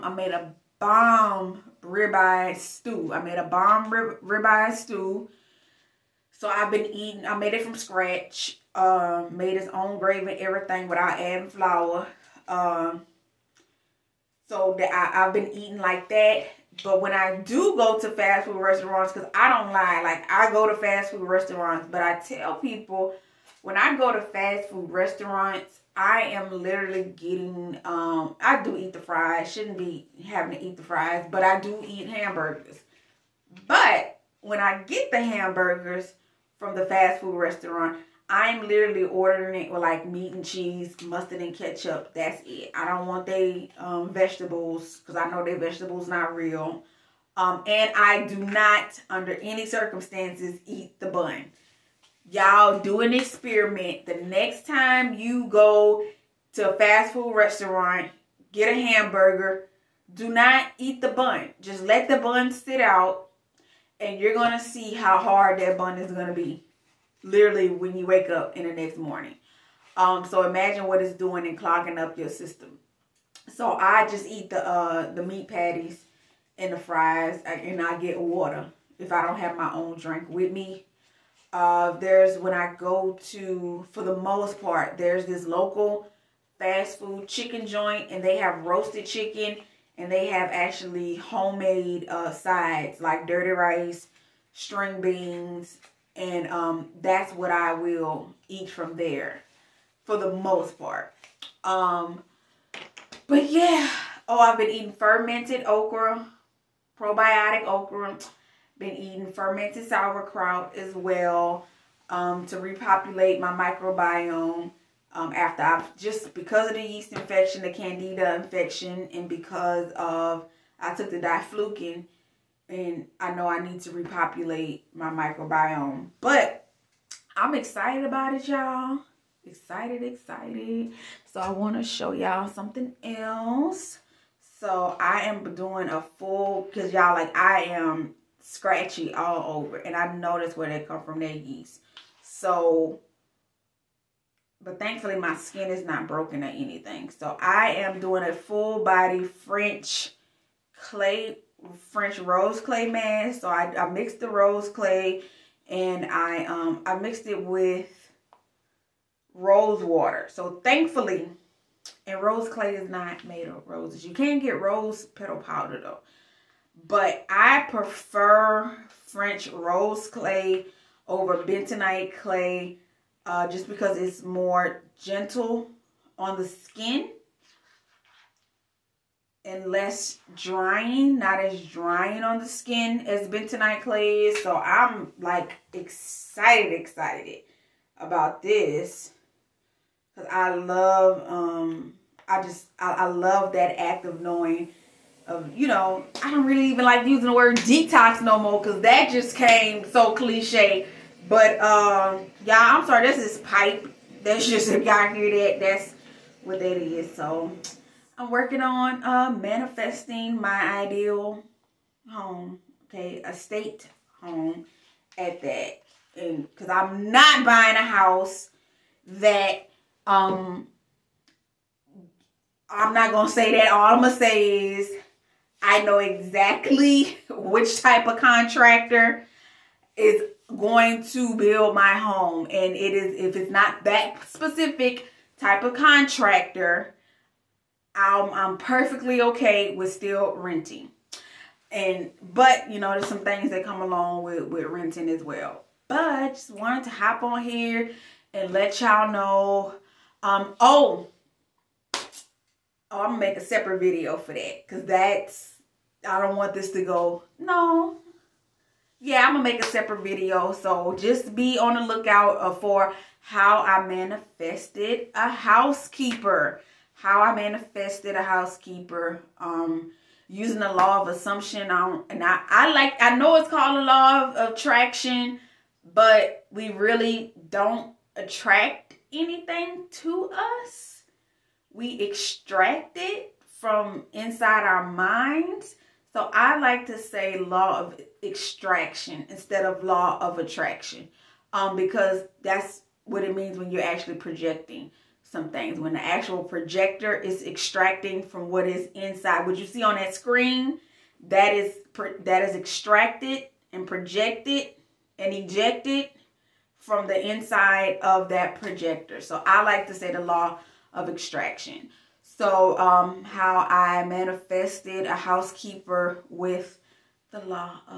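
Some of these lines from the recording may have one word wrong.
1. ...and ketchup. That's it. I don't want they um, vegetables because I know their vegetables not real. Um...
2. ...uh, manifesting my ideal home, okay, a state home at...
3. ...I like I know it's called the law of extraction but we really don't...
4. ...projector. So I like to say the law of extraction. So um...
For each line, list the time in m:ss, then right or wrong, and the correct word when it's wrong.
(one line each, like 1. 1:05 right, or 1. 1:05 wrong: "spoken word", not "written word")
1. 0:41 right
2. 3:29 right
3. 4:32 wrong: "attraction", not "extraction"
4. 5:08 right.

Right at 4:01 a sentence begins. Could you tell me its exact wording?
And, but, you know, there's some things that come along with, with renting as well.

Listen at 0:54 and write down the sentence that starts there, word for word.
The next time you go to a fast food restaurant, get a hamburger, do not eat the bun.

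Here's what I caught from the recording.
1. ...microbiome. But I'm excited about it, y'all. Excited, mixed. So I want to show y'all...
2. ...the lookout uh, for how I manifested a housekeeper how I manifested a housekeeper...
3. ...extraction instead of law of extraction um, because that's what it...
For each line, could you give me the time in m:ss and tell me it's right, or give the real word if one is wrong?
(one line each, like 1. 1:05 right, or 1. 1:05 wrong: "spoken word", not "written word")
1. 2:05 wrong: "excited", not "mixed"
2. 4:21 right
3. 4:48 wrong: "attraction", not "extraction".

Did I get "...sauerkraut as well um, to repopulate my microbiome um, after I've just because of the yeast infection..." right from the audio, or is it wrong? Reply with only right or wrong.
right.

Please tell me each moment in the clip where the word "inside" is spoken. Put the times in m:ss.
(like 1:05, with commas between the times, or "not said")
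4:44, 4:58, 5:07.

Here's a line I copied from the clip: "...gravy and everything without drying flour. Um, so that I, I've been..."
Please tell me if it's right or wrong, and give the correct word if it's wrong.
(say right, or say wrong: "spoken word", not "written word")
wrong: "adding", not "drying".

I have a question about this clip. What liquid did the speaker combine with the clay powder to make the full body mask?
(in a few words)
rose water.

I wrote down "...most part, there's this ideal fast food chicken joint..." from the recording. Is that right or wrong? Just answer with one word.
wrong.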